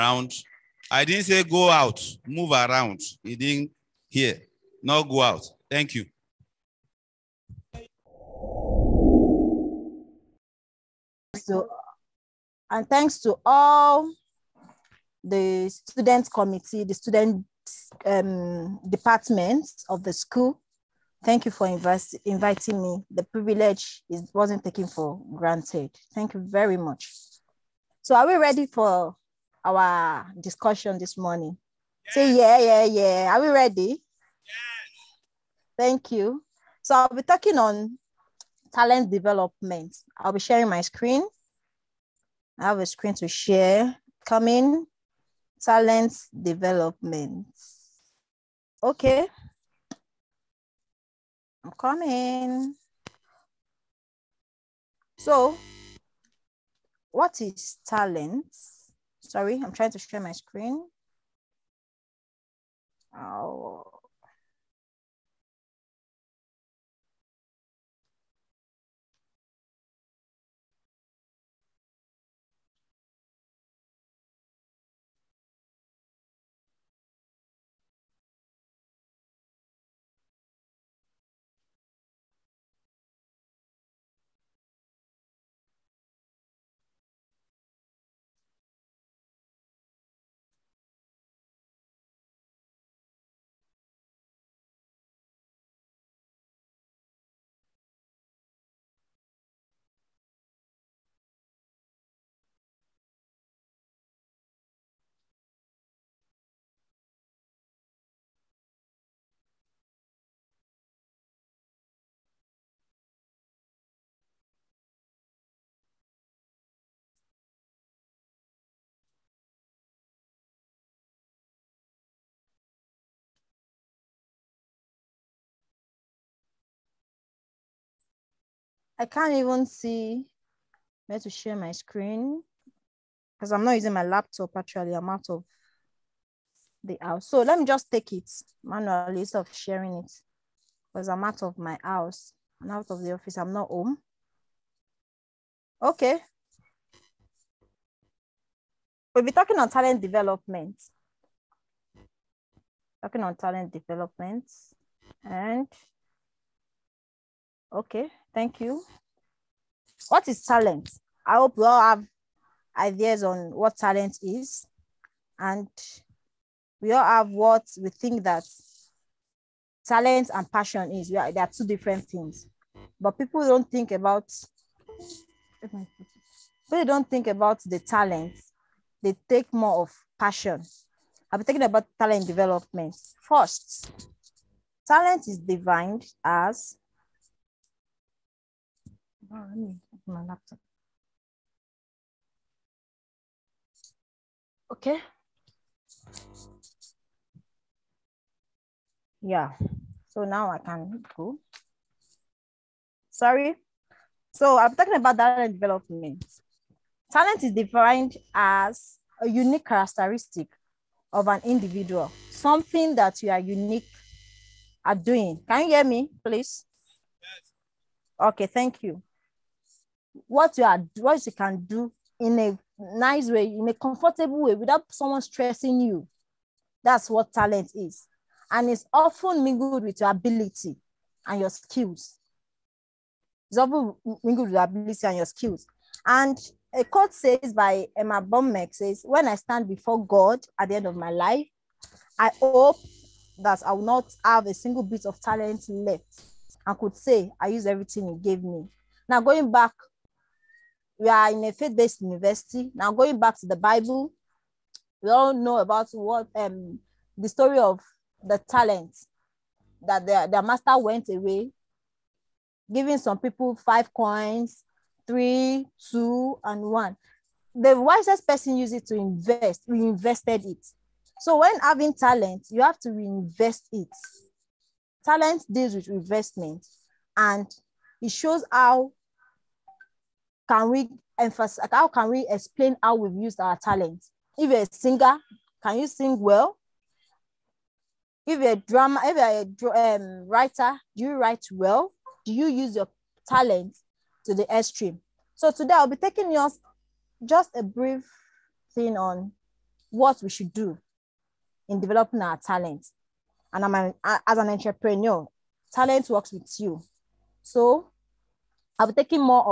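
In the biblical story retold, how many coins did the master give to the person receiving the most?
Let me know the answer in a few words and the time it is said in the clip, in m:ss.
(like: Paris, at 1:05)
5, at 4:23.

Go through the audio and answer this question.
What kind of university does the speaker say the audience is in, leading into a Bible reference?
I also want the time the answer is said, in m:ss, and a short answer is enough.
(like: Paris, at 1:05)
Faith-based university, at 4:11.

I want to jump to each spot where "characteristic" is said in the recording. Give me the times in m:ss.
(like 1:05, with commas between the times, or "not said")
3:29.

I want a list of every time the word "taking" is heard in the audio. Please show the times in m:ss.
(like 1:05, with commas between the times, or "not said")
4:55, 5:08.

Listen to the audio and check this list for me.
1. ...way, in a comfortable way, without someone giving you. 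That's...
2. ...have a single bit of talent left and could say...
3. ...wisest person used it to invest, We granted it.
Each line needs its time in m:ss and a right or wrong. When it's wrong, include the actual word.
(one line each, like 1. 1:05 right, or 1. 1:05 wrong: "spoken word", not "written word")
1. 3:43 wrong: "stressing", not "giving"
2. 4:04 right
3. 4:27 wrong: "invested", not "granted".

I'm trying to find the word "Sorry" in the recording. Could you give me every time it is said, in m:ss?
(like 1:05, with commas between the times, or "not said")
0:59, 3:23.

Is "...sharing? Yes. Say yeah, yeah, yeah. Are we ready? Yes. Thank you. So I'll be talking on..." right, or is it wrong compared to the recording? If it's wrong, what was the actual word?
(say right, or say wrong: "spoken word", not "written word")
wrong: "morning", not "sharing".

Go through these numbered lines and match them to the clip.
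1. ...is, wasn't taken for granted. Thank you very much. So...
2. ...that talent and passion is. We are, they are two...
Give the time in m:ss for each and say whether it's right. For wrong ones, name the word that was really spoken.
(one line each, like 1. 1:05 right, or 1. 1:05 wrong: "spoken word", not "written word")
1. 0:24 right
2. 2:48 right.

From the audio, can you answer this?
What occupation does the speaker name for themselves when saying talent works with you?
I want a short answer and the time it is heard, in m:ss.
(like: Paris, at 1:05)
Entrepreneur, at 5:04.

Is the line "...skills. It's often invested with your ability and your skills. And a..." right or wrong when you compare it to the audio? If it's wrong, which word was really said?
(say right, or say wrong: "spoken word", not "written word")
wrong: "mingled", not "invested".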